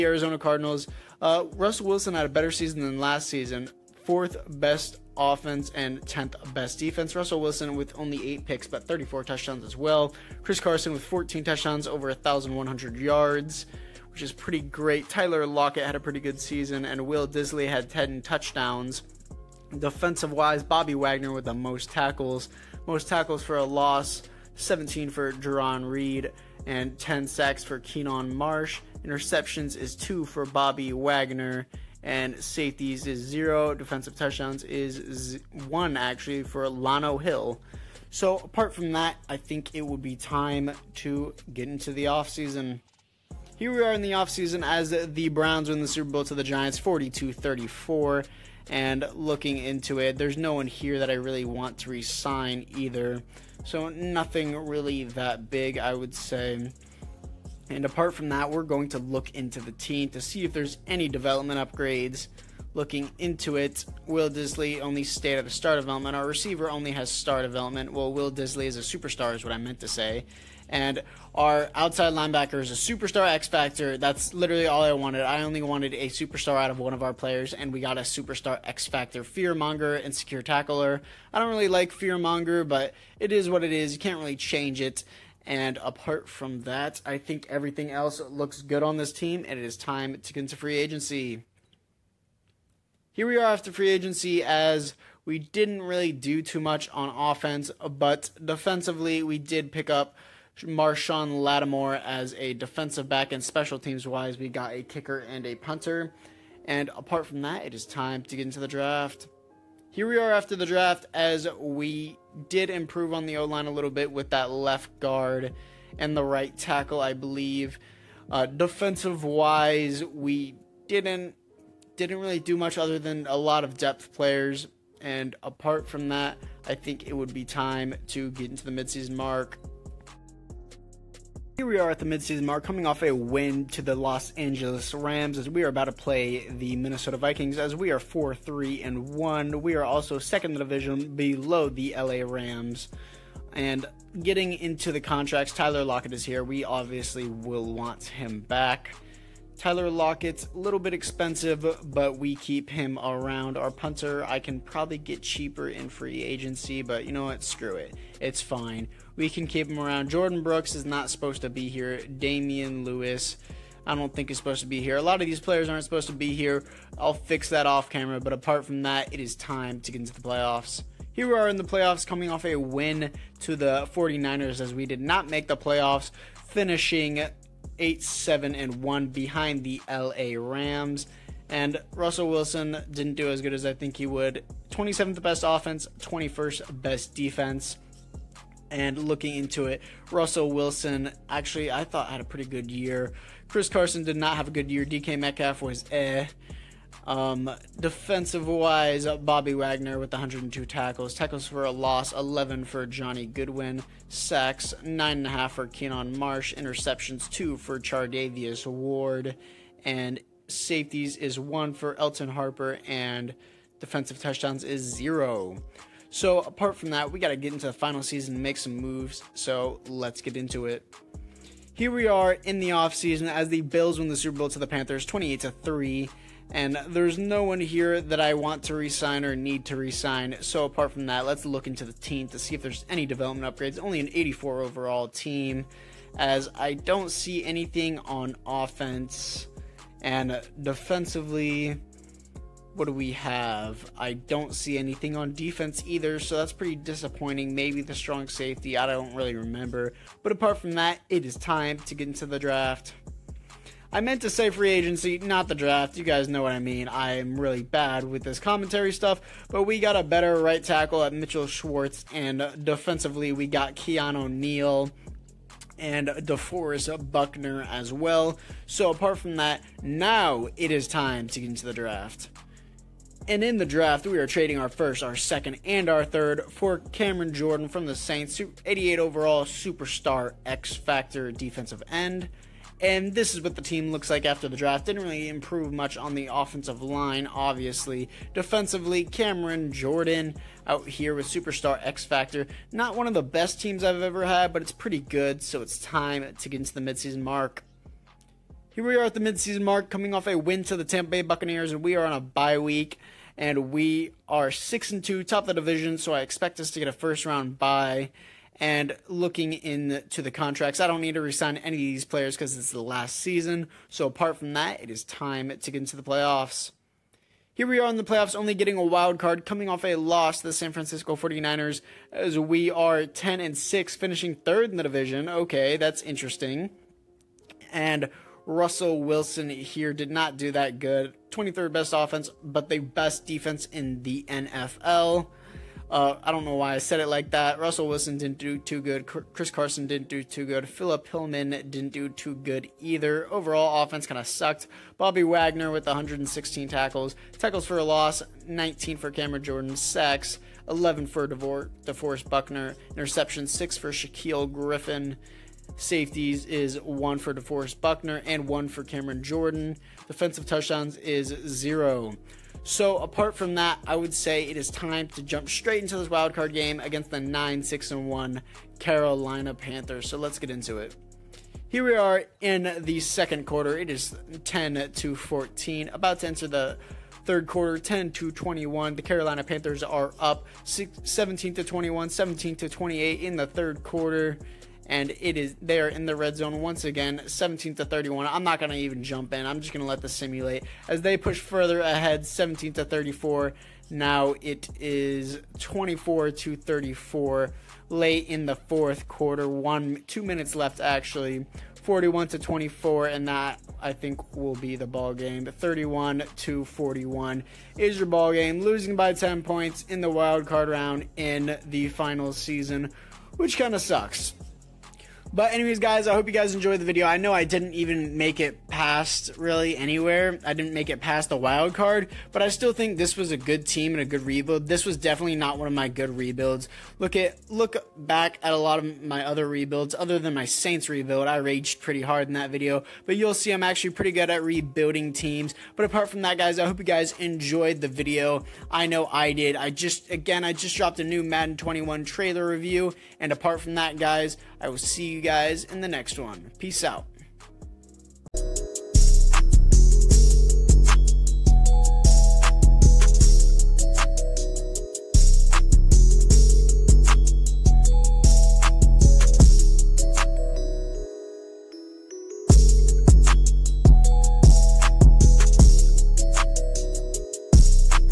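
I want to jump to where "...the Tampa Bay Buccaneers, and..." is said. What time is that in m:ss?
5:00.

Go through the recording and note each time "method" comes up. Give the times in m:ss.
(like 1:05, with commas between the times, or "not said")
not said.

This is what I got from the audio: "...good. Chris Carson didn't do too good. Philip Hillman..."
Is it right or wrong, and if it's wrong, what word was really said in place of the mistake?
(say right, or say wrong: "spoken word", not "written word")
right.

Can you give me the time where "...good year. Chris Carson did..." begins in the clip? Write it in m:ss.
3:12.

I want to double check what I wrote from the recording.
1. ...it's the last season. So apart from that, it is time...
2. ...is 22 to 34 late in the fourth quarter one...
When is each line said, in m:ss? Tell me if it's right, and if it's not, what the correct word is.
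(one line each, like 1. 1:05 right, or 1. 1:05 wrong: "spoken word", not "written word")
1. 5:12 right
2. 6:34 wrong: "24", not "22".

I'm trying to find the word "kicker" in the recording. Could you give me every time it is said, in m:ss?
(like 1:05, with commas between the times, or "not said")
1:44.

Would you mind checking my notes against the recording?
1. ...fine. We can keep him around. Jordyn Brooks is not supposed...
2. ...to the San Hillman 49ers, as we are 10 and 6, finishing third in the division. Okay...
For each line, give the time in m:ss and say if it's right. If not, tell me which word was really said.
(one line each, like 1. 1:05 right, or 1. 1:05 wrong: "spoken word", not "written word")
1. 2:38 right
2. 5:20 wrong: "Francisco", not "Hillman".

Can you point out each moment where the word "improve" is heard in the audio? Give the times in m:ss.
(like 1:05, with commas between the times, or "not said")
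1:52, 4:45.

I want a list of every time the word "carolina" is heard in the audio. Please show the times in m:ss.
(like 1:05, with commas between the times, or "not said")
6:08, 6:19.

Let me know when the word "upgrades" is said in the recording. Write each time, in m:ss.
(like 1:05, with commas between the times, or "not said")
1:01, 3:53.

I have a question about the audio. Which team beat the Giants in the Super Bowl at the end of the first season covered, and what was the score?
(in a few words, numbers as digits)
Browns, 42-34.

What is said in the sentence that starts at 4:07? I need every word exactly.
Maybe the strong safety, I don't really remember.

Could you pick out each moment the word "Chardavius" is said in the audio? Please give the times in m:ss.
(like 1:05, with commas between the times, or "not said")
3:27.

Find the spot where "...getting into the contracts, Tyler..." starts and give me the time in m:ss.
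2:24.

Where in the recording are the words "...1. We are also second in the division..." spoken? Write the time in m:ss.
2:19.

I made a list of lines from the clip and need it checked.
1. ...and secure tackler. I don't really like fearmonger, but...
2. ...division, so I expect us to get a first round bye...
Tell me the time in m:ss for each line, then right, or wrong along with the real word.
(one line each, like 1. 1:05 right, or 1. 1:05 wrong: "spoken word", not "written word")
1. 1:20 right
2. 5:05 right.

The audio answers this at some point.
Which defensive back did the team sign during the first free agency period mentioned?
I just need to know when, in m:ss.
1:40.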